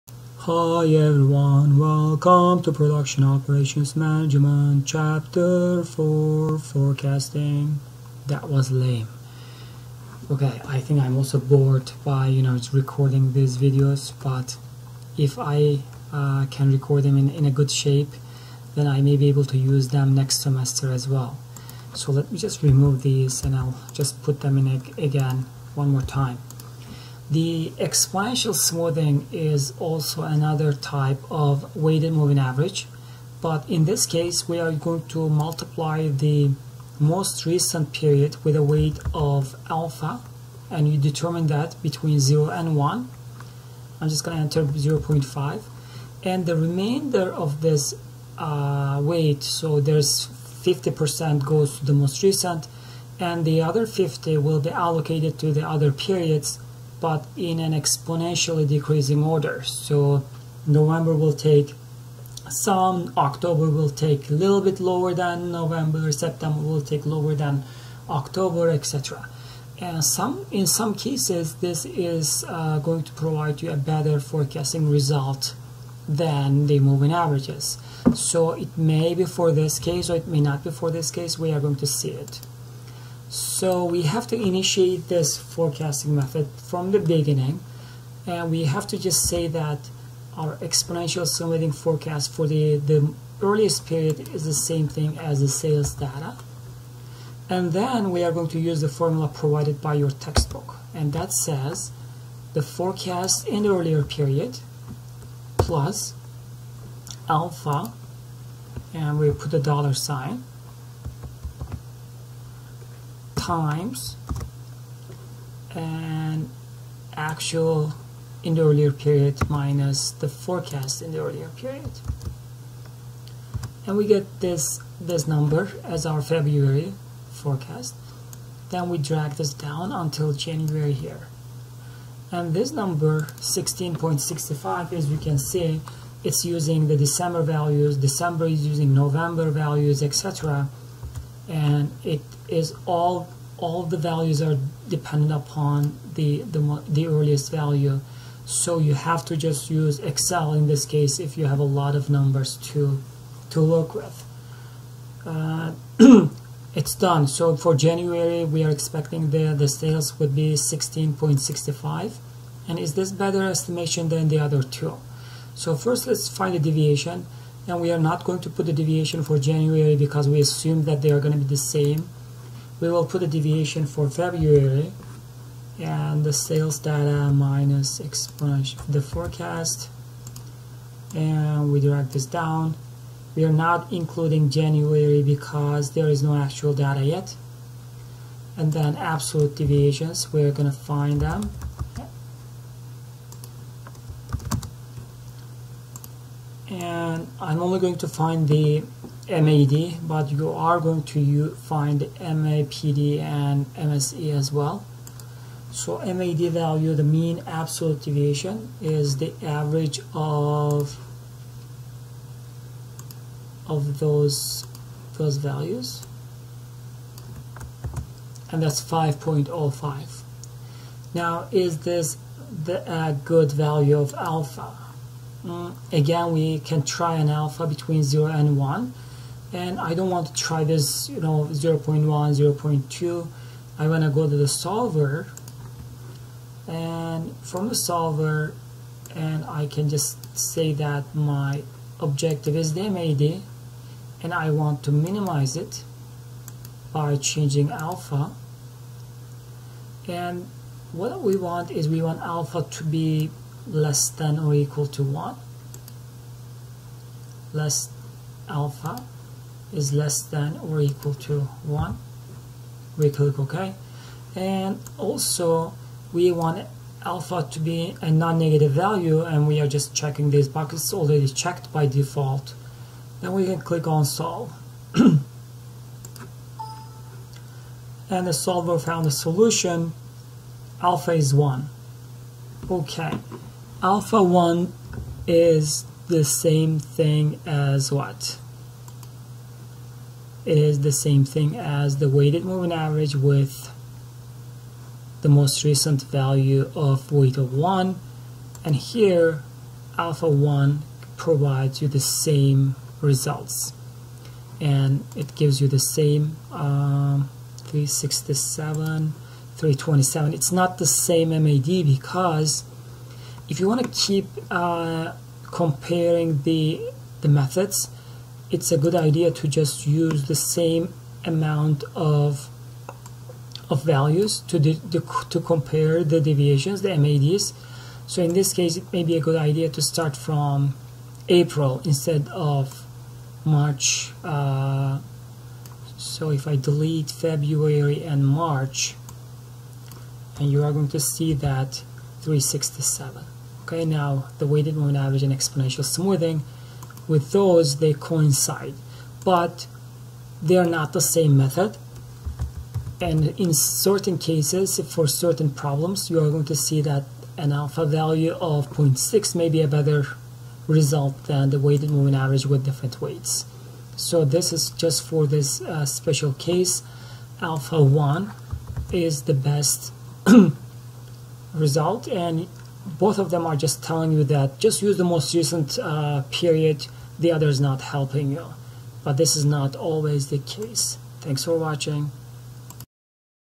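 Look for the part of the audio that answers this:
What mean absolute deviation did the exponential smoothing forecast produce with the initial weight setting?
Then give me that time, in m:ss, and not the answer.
3:38.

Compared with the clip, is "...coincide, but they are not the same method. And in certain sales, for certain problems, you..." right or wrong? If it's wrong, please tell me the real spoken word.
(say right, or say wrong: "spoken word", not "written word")
wrong: "cases", not "sales".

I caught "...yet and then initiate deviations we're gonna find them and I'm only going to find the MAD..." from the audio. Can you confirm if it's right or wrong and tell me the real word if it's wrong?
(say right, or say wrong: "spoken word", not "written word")
wrong: "absolute", not "initiate".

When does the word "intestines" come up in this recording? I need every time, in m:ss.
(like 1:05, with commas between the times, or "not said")
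not said.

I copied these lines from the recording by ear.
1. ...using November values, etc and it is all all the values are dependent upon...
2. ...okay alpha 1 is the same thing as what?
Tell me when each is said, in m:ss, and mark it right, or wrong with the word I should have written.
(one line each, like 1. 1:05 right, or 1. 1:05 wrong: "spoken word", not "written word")
1. 2:18 right
2. 4:42 right.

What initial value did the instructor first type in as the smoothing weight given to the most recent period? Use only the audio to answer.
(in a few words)
0.5.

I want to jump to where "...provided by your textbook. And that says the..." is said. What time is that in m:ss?
1:39.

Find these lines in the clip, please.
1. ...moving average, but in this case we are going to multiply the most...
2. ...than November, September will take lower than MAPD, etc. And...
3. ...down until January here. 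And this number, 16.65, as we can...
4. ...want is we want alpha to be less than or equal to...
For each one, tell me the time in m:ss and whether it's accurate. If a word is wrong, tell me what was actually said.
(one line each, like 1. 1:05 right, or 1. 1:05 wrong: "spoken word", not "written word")
1. 0:32 right
2. 1:05 wrong: "October", not "MAPD"
3. 2:09 right
4. 4:11 right.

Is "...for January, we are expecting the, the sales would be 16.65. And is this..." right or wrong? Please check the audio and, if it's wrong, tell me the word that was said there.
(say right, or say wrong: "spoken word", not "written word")
right.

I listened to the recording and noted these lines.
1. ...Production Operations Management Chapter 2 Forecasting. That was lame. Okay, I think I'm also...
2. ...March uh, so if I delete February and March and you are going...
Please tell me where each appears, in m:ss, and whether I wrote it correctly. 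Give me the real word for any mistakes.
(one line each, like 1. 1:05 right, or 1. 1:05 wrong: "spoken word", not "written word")
1. 0:02 wrong: "4", not "2"
2. 5:33 right.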